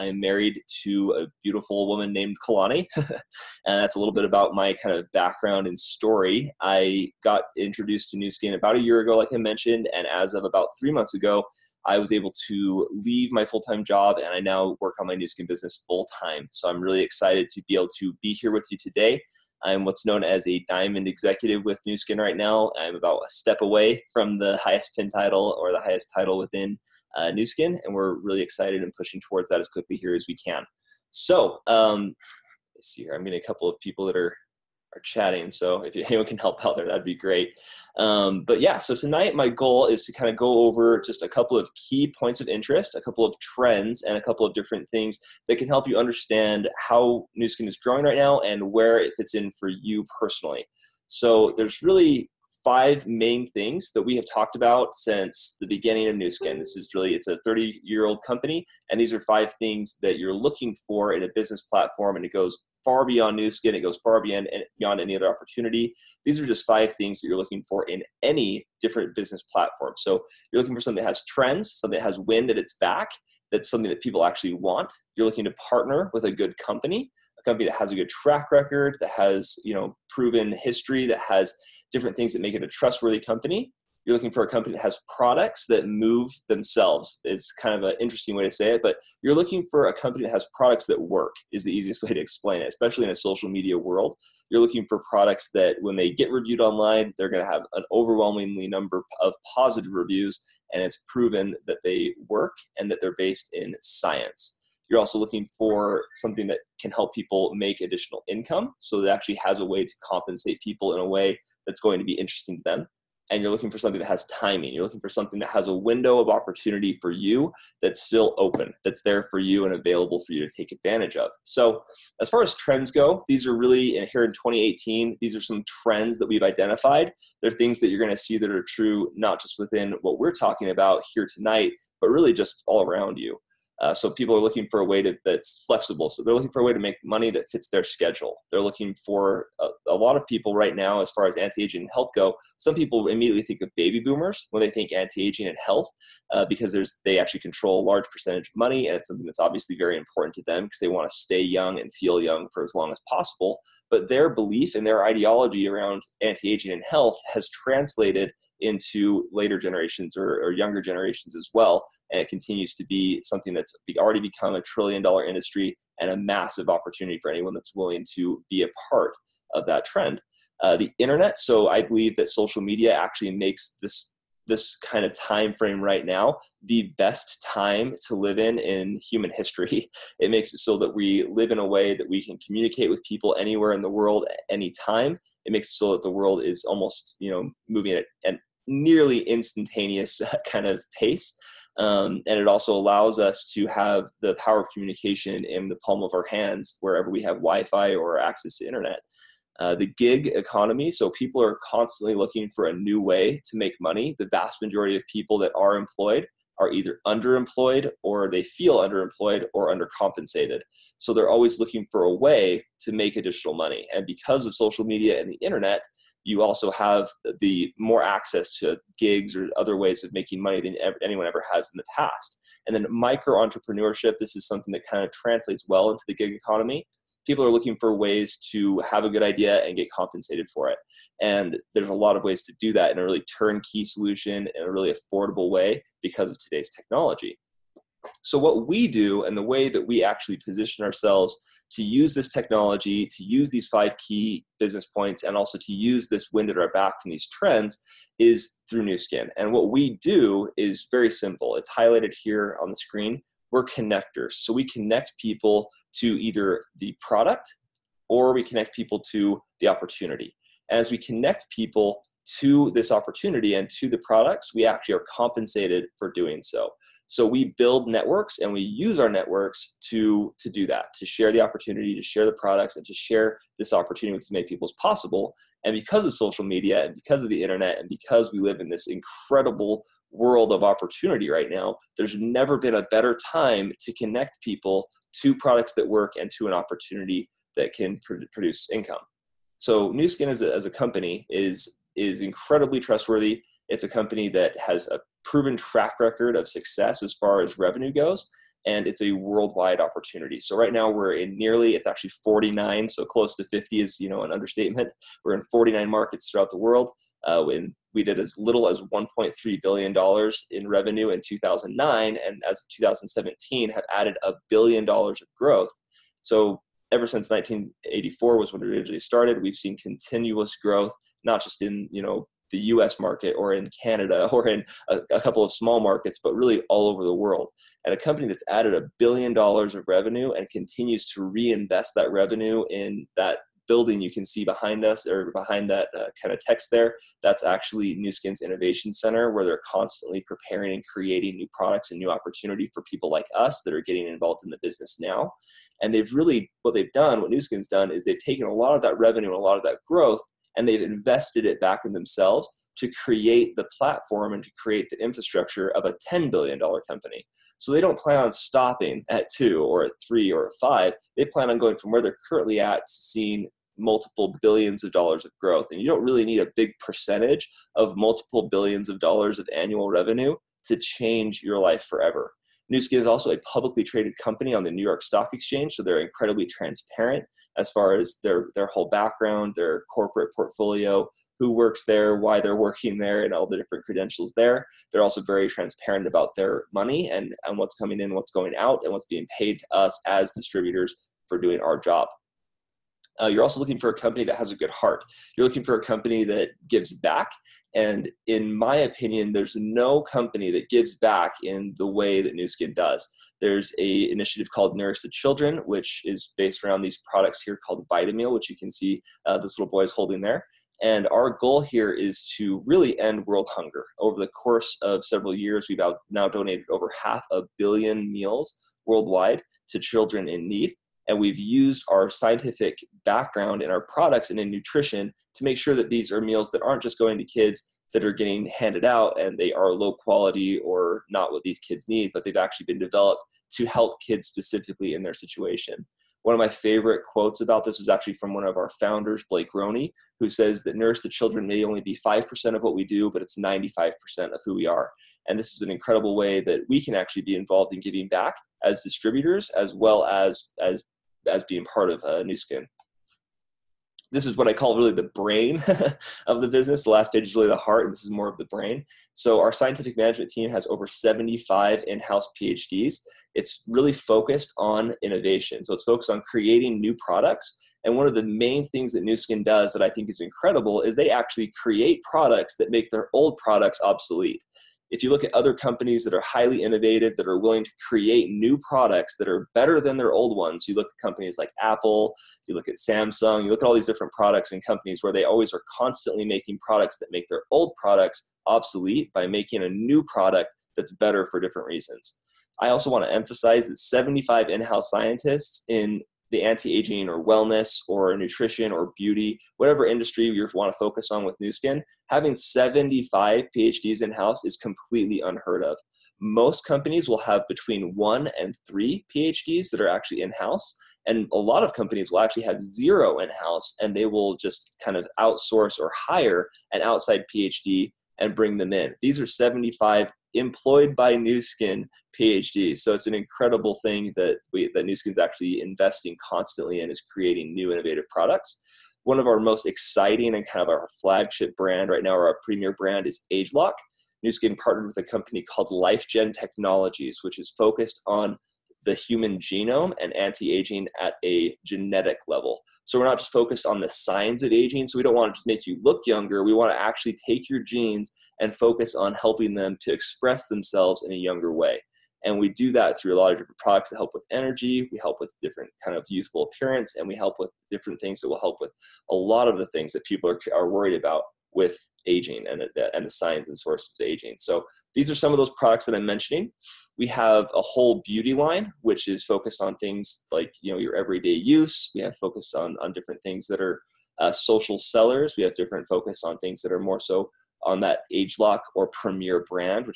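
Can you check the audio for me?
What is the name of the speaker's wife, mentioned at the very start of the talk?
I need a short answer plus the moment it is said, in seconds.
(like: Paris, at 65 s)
Kalani, at 2 s.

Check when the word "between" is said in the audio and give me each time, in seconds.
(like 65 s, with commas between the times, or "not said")
507 s.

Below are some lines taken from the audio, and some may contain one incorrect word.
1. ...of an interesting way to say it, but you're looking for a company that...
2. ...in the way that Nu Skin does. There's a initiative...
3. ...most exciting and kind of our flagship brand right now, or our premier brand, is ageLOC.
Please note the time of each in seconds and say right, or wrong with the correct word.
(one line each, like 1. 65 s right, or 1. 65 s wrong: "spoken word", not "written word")
1. 87 s right
2. 401 s right
3. 529 s right.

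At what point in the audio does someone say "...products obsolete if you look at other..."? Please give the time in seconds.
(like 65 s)
473 s.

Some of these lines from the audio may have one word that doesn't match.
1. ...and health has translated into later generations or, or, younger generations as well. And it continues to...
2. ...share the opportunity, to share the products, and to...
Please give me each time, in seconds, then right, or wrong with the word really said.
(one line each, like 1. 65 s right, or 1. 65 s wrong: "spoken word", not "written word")
1. 156 s right
2. 271 s right.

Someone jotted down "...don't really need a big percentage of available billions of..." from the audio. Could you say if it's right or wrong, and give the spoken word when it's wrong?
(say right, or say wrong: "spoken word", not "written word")
wrong: "multiple", not "available".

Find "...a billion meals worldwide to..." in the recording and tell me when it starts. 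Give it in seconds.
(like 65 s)
417 s.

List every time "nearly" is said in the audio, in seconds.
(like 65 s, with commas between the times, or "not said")
188 s, 301 s.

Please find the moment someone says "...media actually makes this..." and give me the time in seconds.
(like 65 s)
172 s.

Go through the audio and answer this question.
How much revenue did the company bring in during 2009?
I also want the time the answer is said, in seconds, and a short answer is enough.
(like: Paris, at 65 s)
$1.3 billion, at 308 s.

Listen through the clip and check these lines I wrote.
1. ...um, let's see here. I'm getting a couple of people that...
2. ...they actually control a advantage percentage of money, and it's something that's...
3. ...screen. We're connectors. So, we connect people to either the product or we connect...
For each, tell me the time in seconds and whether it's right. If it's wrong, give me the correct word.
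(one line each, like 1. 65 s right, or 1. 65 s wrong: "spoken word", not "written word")
1. 31 s right
2. 147 s wrong: "large", not "advantage"
3. 252 s right.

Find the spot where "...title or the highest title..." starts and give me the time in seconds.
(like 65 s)
25 s.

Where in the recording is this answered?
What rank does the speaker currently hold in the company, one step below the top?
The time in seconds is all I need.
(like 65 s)
20 s.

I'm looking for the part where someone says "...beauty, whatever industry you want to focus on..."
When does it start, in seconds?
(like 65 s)
498 s.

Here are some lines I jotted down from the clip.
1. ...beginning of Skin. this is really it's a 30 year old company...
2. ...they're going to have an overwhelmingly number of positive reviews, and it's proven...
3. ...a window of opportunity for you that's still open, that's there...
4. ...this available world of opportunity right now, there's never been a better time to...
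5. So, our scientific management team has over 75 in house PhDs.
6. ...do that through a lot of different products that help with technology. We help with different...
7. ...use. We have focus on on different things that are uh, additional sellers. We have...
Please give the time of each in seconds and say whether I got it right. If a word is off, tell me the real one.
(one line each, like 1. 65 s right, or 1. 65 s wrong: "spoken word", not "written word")
1. 55 s right
2. 97 s right
3. 115 s right
4. 278 s wrong: "incredible", not "available"
5. 459 s right
6. 552 s wrong: "energy", not "technology"
7. 571 s wrong: "social", not "additional".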